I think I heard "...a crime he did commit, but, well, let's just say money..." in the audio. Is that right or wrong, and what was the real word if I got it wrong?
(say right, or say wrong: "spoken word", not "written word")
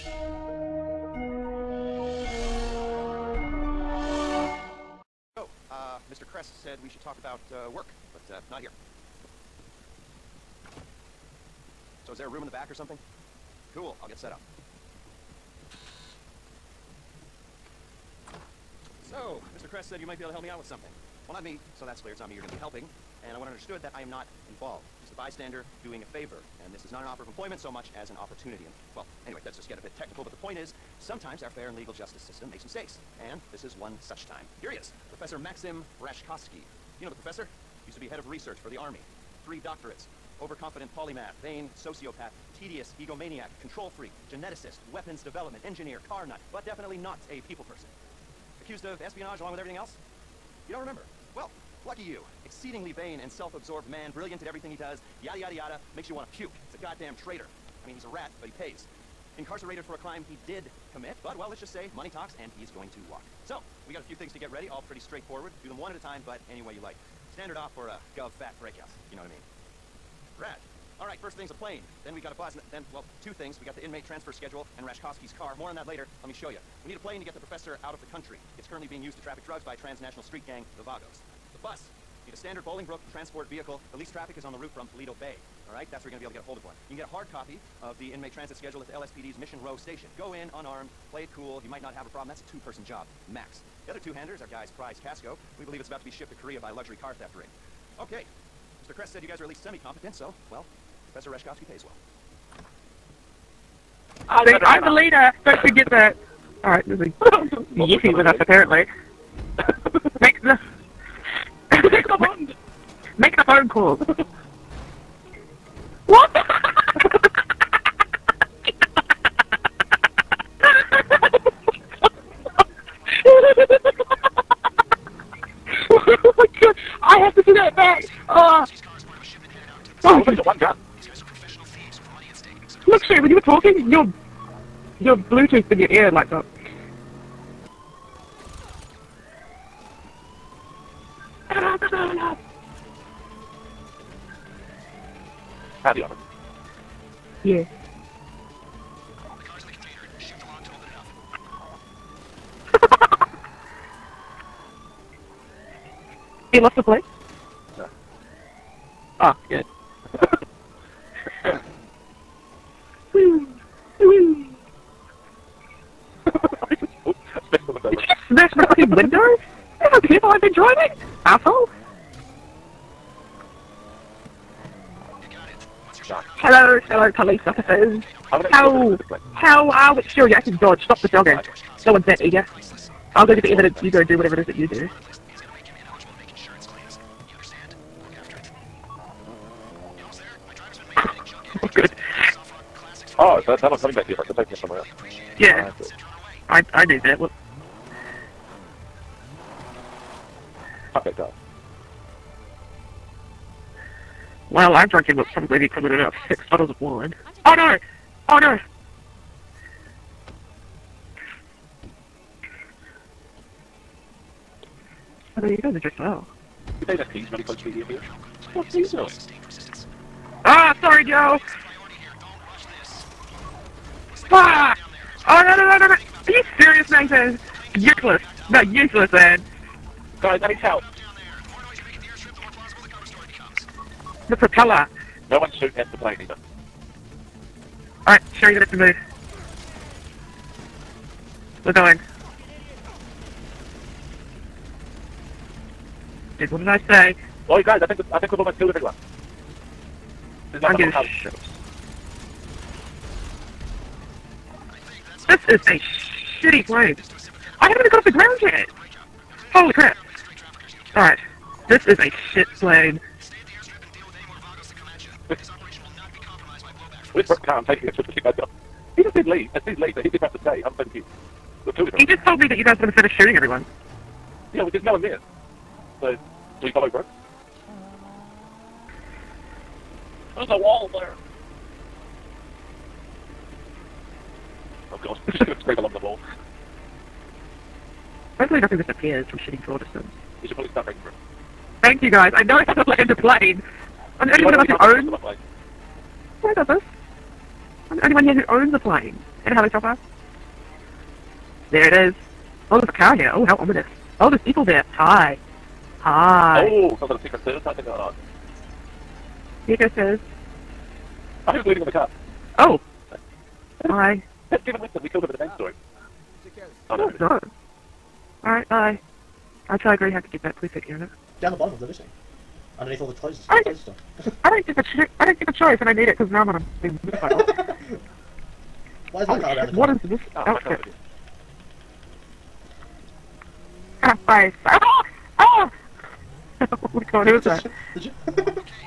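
right.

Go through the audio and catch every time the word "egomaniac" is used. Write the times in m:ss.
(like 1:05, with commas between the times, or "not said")
0:42.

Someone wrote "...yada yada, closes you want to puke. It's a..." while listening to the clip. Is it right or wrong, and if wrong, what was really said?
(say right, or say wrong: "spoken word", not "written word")
wrong: "makes", not "closes".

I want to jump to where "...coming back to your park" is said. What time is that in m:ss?
3:13.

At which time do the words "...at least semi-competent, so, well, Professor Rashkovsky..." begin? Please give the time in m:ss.
1:39.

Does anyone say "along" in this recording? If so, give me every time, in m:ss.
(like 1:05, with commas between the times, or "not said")
0:49, 4:45.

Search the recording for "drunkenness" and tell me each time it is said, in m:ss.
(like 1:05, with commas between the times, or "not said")
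not said.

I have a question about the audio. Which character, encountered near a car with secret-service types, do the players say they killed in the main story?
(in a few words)
Devin Weston.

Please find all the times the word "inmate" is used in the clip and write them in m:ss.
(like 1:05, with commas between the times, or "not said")
1:13, 1:28.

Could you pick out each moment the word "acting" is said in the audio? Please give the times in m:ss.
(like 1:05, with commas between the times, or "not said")
3:00.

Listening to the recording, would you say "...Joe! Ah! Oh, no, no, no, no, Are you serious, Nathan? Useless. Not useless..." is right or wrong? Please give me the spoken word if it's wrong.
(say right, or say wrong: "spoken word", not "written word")
right.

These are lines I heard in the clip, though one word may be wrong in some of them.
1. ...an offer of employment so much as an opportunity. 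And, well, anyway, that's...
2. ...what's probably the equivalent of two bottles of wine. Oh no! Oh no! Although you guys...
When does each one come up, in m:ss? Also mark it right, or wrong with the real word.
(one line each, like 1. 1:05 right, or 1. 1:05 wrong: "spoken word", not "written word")
1. 0:27 right
2. 3:25 wrong: "six", not "two".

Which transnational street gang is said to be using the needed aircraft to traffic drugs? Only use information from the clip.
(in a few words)
the Vagos.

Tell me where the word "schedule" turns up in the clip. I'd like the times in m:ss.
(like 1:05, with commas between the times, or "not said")
1:14, 1:28.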